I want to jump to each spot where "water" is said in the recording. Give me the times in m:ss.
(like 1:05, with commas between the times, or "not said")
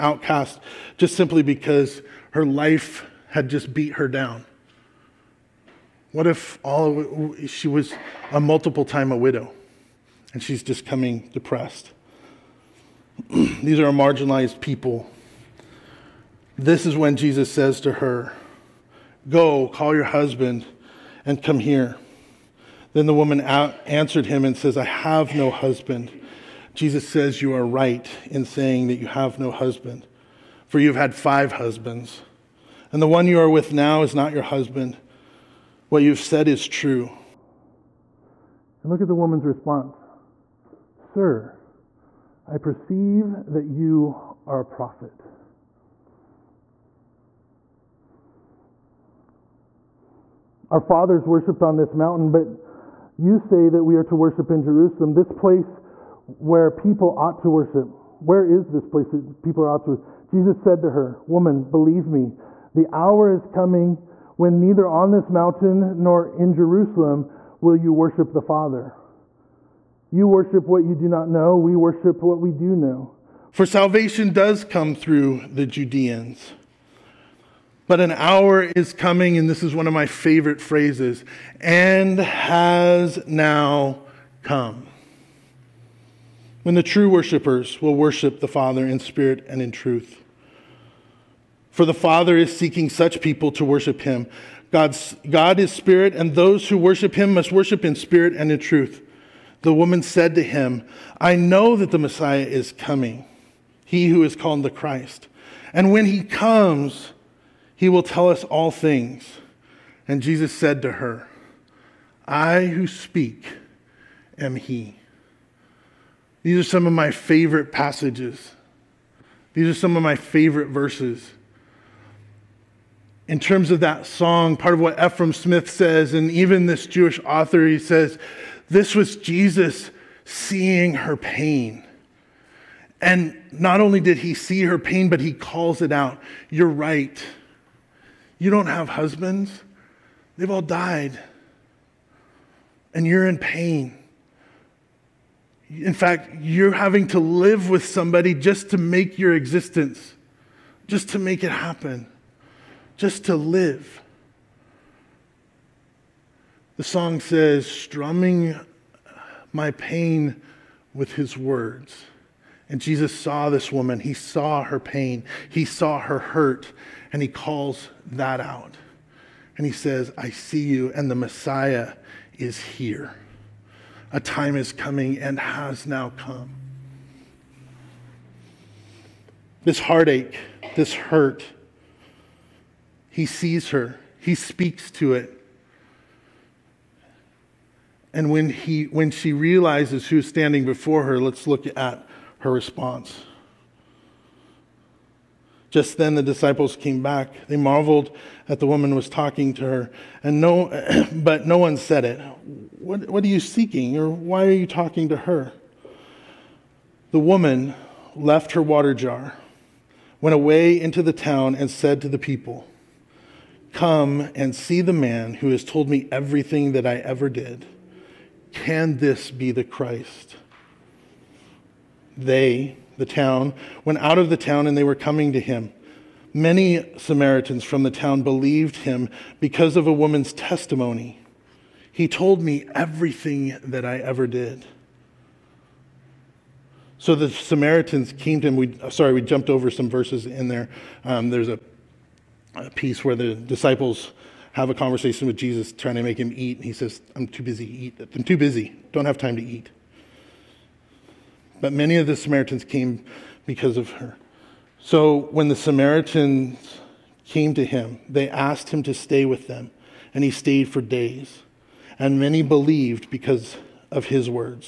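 3:28.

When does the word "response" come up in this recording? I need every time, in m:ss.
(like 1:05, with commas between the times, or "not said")
0:39, 3:12.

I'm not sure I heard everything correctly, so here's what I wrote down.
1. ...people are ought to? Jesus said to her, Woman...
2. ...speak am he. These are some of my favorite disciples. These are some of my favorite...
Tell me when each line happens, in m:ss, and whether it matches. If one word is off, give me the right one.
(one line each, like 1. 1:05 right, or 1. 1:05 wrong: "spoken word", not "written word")
1. 0:59 right
2. 1:52 wrong: "passages", not "disciples".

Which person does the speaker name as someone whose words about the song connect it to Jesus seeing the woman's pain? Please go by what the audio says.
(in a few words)
Efrem Smith.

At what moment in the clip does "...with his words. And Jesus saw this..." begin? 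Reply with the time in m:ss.
2:40.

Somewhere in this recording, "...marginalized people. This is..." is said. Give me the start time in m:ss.
0:13.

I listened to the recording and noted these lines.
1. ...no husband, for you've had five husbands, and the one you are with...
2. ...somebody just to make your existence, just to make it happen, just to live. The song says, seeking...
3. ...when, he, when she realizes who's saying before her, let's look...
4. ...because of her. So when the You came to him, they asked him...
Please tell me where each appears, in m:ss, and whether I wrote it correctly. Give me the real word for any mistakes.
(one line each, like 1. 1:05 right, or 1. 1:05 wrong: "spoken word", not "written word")
1. 0:29 right
2. 2:27 wrong: "strumming", not "seeking"
3. 3:08 wrong: "standing", not "saying"
4. 4:13 wrong: "Samaritans", not "You".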